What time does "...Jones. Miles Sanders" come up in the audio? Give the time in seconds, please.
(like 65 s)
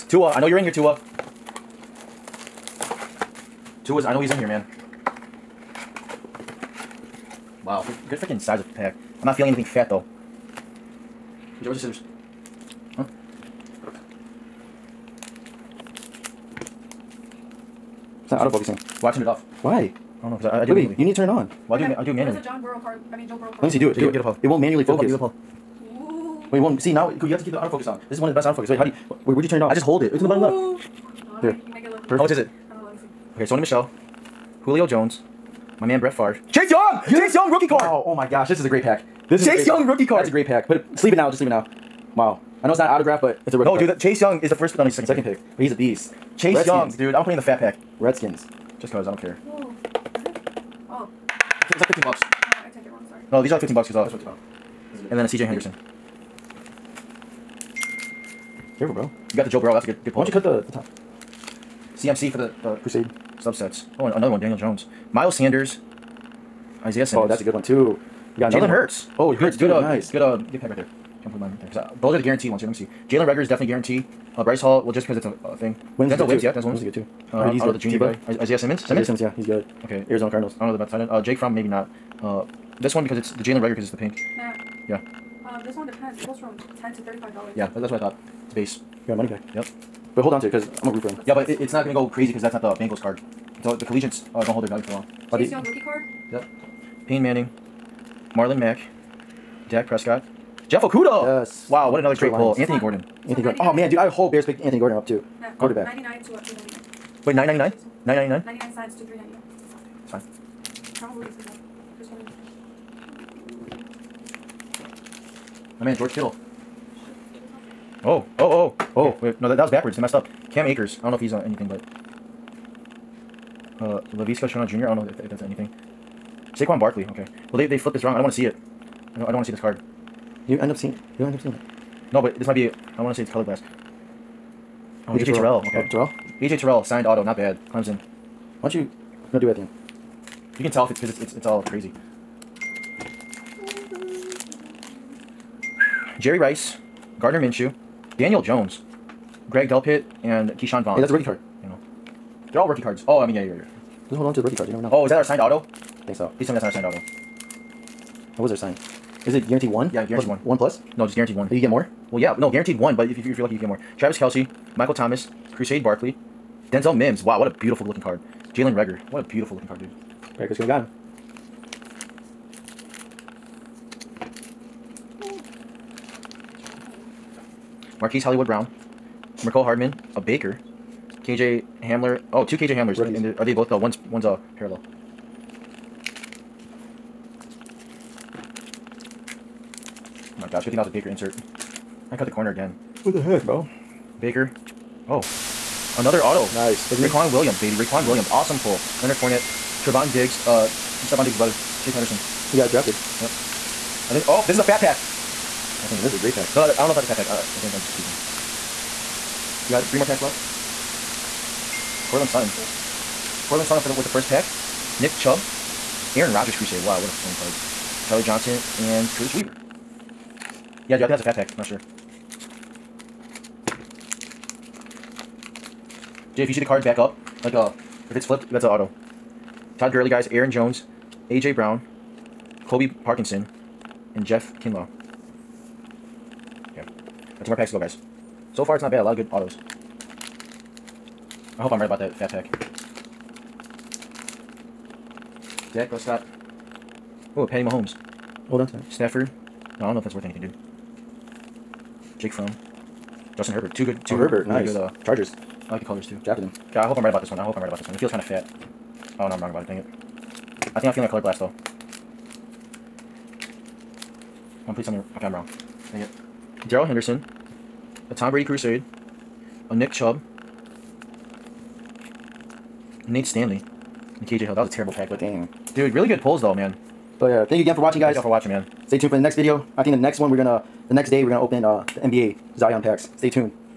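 64 s.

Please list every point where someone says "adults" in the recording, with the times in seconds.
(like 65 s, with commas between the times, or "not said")
not said.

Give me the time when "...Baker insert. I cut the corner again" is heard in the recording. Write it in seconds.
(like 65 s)
190 s.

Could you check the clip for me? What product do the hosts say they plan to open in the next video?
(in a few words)
NBA Zion packs.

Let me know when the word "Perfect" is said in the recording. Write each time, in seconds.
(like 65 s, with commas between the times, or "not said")
32 s.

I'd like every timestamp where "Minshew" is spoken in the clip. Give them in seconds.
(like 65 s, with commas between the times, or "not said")
147 s.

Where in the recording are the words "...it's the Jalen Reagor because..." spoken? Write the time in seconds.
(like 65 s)
83 s.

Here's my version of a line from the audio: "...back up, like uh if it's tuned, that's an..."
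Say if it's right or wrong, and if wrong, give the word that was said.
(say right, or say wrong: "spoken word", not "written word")
wrong: "flipped", not "tuned".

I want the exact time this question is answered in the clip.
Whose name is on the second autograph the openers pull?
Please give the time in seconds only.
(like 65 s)
197 s.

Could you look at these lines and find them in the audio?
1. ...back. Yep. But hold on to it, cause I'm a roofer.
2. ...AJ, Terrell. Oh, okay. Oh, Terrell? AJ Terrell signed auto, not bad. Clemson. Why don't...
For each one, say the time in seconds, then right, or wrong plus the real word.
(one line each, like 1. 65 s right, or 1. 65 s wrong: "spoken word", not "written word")
1. 89 s right
2. 135 s right.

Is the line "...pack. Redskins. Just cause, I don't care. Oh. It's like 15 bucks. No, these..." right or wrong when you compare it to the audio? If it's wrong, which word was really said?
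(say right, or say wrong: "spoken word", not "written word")
right.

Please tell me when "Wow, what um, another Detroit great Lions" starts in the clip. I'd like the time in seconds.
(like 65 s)
101 s.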